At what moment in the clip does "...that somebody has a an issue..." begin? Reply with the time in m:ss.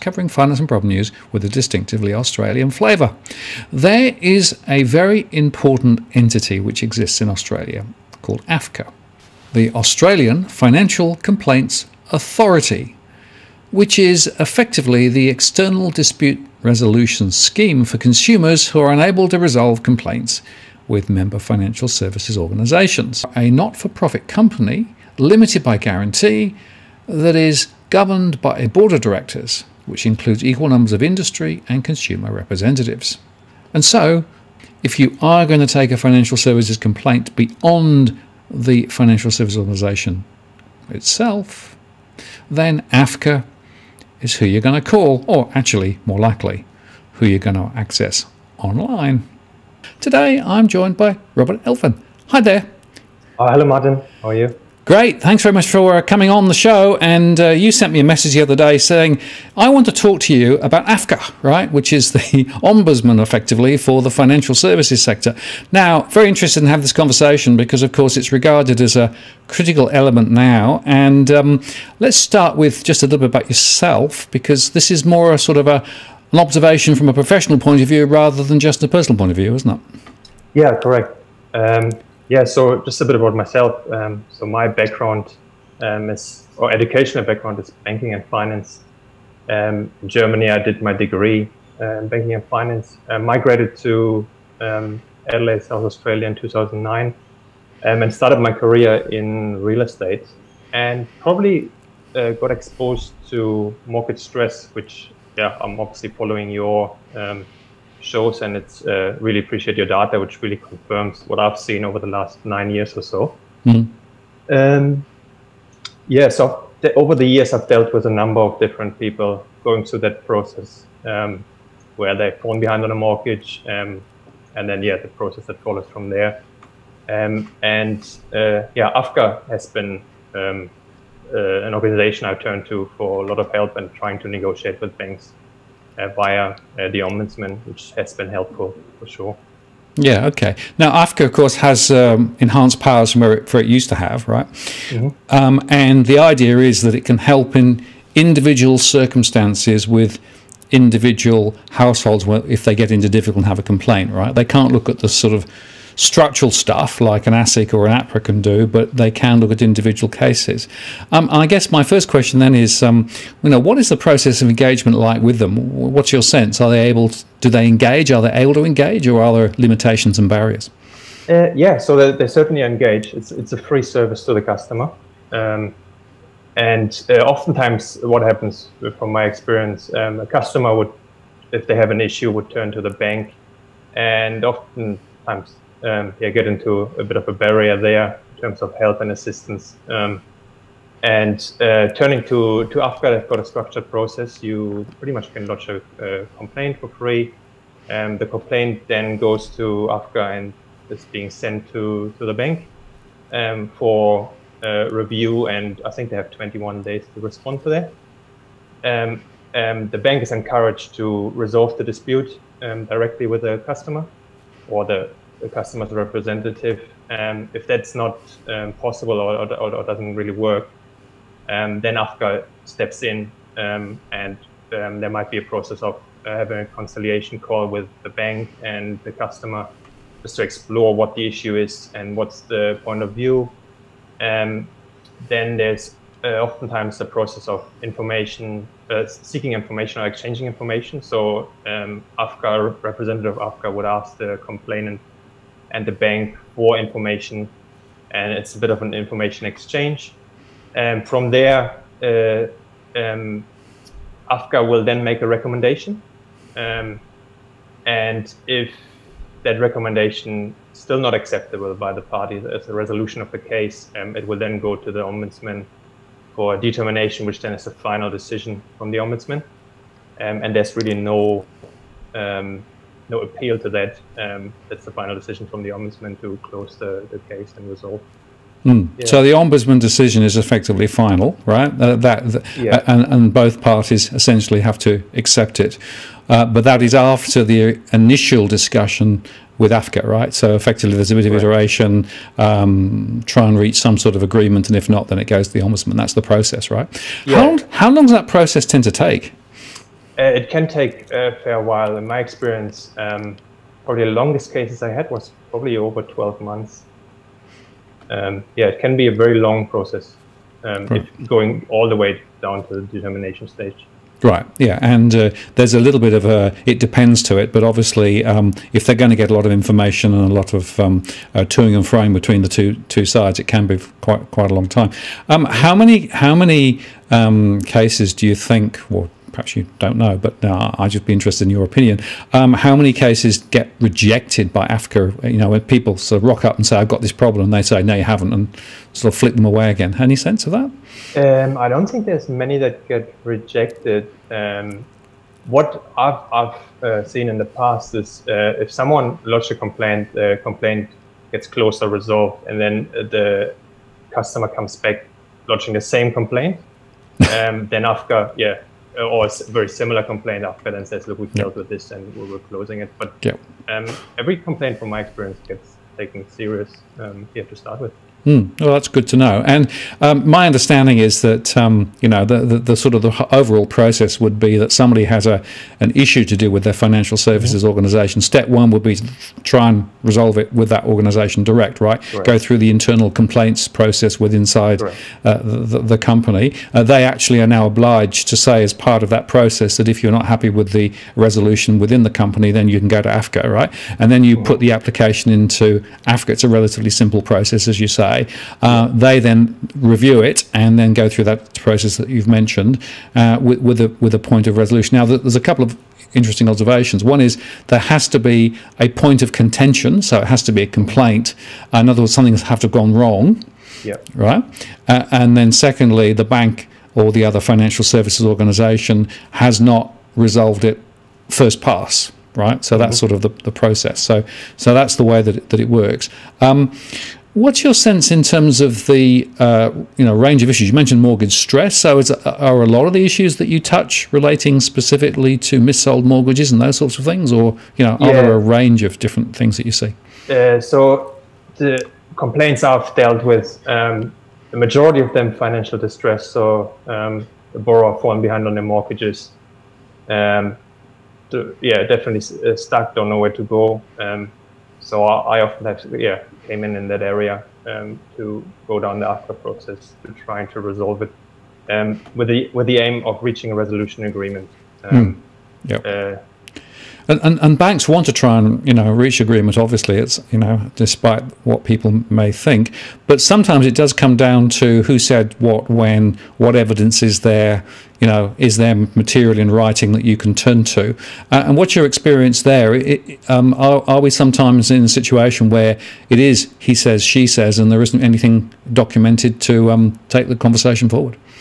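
6:14.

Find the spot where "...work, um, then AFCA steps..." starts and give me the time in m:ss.
3:40.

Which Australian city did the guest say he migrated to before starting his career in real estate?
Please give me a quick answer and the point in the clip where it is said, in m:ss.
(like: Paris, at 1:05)
Adelaide, at 1:35.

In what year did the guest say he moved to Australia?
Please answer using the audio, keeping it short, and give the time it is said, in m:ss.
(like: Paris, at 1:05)
2009, at 1:36.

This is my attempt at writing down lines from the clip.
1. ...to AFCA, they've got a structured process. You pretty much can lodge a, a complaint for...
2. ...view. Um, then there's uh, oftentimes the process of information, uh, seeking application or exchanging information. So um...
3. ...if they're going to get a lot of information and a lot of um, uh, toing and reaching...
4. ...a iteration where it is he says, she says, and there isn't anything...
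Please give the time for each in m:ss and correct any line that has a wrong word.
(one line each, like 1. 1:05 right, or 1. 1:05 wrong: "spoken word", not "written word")
1. 3:12 right
2. 3:53 wrong: "information", not "application"
3. 5:18 wrong: "froing", not "reaching"
4. 8:04 wrong: "situation", not "iteration".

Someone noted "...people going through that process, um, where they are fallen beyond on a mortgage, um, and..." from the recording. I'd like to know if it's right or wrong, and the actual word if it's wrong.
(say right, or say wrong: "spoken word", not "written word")
wrong: "behind", not "beyond".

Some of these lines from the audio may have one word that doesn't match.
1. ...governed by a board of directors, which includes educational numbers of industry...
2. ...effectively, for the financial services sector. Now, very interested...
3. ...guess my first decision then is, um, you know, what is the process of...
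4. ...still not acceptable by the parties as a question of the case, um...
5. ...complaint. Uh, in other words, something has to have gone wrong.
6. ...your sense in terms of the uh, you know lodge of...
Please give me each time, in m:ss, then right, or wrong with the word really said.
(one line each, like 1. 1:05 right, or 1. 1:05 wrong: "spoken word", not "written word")
1. 0:27 wrong: "equal", not "educational"
2. 1:03 right
3. 2:41 wrong: "question", not "decision"
4. 4:20 wrong: "resolution", not "question"
5. 6:50 right
6. 7:07 wrong: "range", not "lodge".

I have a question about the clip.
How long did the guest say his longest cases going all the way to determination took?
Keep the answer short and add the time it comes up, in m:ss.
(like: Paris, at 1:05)
Over 12 months, at 5:05.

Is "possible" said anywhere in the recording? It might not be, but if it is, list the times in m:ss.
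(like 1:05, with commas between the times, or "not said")
3:38.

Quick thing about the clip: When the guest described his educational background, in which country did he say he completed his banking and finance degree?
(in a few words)
Germany.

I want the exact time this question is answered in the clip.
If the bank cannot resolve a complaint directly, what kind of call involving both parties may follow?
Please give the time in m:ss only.
3:46.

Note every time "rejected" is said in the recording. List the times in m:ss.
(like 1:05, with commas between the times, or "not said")
5:33, 5:43.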